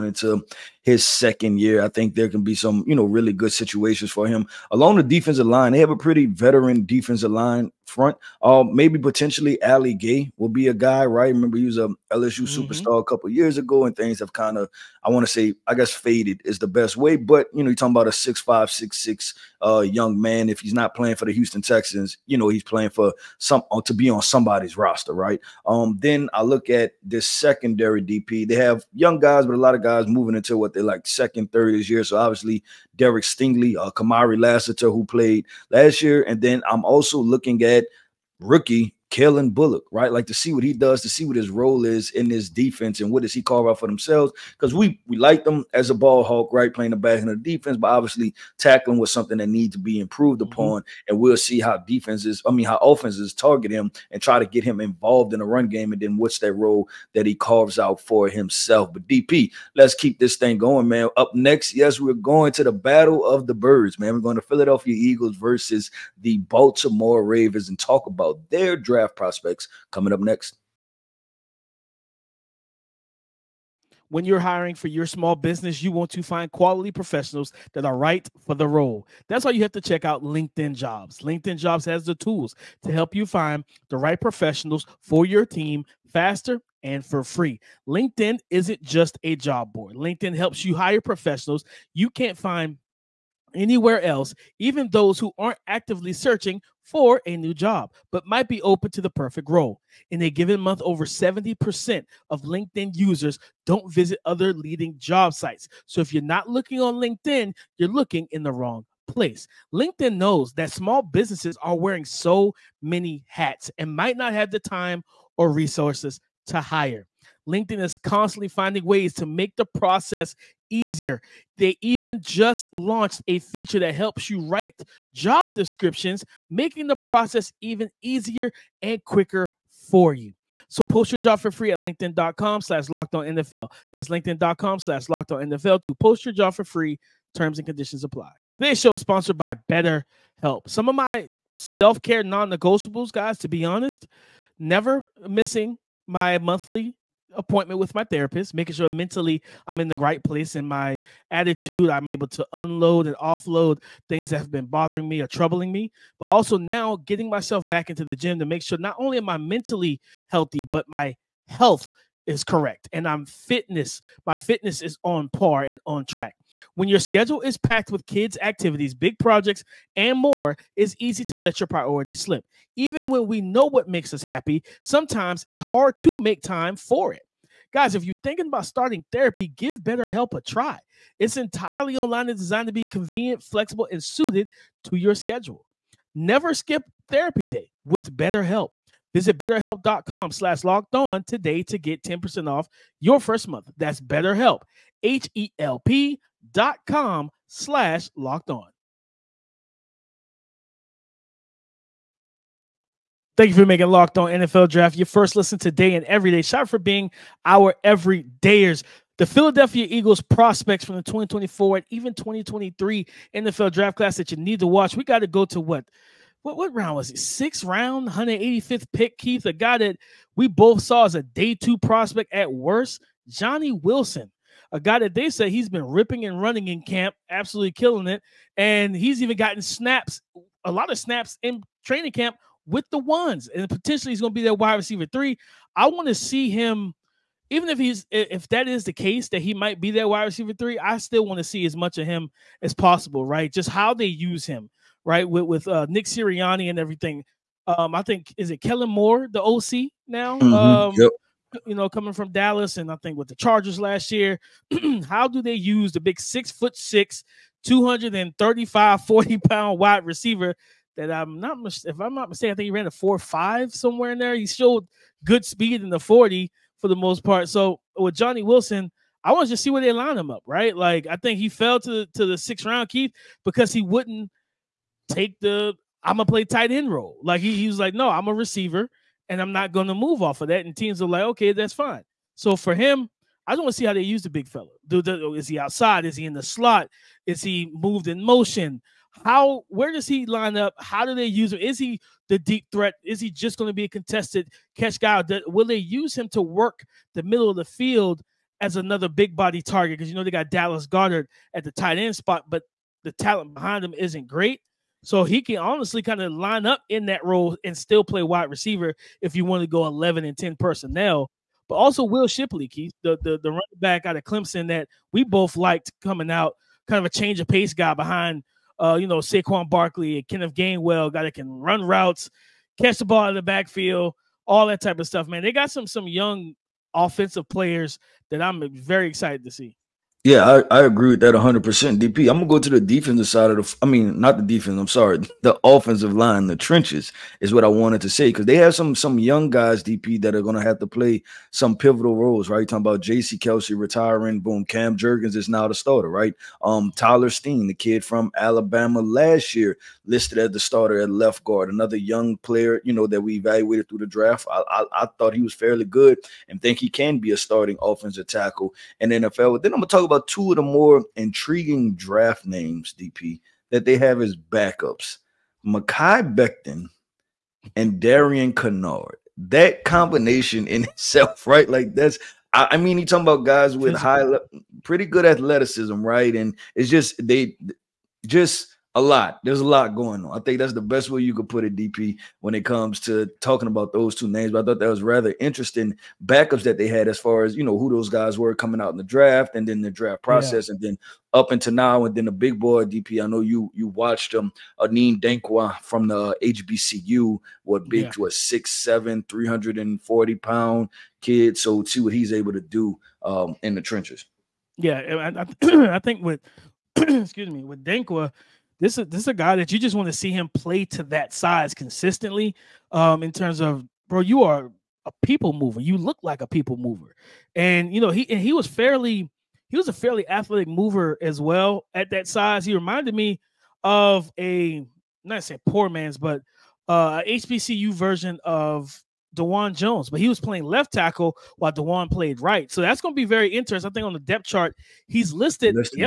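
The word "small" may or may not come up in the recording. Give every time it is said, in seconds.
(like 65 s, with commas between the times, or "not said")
75 s, 110 s.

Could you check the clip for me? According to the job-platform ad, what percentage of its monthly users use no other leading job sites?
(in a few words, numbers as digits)
70%.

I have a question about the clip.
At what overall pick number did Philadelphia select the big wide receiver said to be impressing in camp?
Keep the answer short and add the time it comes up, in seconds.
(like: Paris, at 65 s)
185, at 218 s.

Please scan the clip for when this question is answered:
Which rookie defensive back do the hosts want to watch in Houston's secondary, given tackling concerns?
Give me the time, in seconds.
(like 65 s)
39 s.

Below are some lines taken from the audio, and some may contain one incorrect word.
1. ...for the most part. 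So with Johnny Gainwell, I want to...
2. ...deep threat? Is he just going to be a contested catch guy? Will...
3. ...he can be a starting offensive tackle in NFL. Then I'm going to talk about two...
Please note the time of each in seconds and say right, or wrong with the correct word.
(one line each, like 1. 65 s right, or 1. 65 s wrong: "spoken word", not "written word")
1. 266 s wrong: "Wilson", not "Gainwell"
2. 292 s right
3. 356 s right.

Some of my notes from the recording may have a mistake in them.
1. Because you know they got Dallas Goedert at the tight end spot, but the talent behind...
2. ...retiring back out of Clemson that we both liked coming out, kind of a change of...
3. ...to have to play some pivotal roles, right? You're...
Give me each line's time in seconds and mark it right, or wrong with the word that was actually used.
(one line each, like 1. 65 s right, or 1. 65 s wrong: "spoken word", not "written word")
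1. 299 s right
2. 313 s wrong: "running", not "retiring"
3. 340 s right.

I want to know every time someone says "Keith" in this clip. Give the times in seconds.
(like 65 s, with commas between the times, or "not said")
219 s, 272 s, 312 s.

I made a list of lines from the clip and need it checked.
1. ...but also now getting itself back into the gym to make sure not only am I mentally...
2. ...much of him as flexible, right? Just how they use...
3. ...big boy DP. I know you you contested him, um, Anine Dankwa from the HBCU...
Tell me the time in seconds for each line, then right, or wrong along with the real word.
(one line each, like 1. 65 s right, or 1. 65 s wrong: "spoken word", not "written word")
1. 156 s wrong: "myself", not "itself"
2. 241 s wrong: "possible", not "flexible"
3. 392 s wrong: "watched", not "contested".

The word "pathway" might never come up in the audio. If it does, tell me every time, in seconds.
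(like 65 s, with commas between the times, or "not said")
not said.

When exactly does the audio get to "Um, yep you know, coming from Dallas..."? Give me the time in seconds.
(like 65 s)
250 s.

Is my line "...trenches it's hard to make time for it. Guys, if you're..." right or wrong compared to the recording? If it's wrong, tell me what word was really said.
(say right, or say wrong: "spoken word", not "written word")
wrong: "sometimes", not "trenches".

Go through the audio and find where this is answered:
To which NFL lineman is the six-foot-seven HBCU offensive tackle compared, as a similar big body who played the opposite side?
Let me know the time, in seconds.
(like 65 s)
429 s.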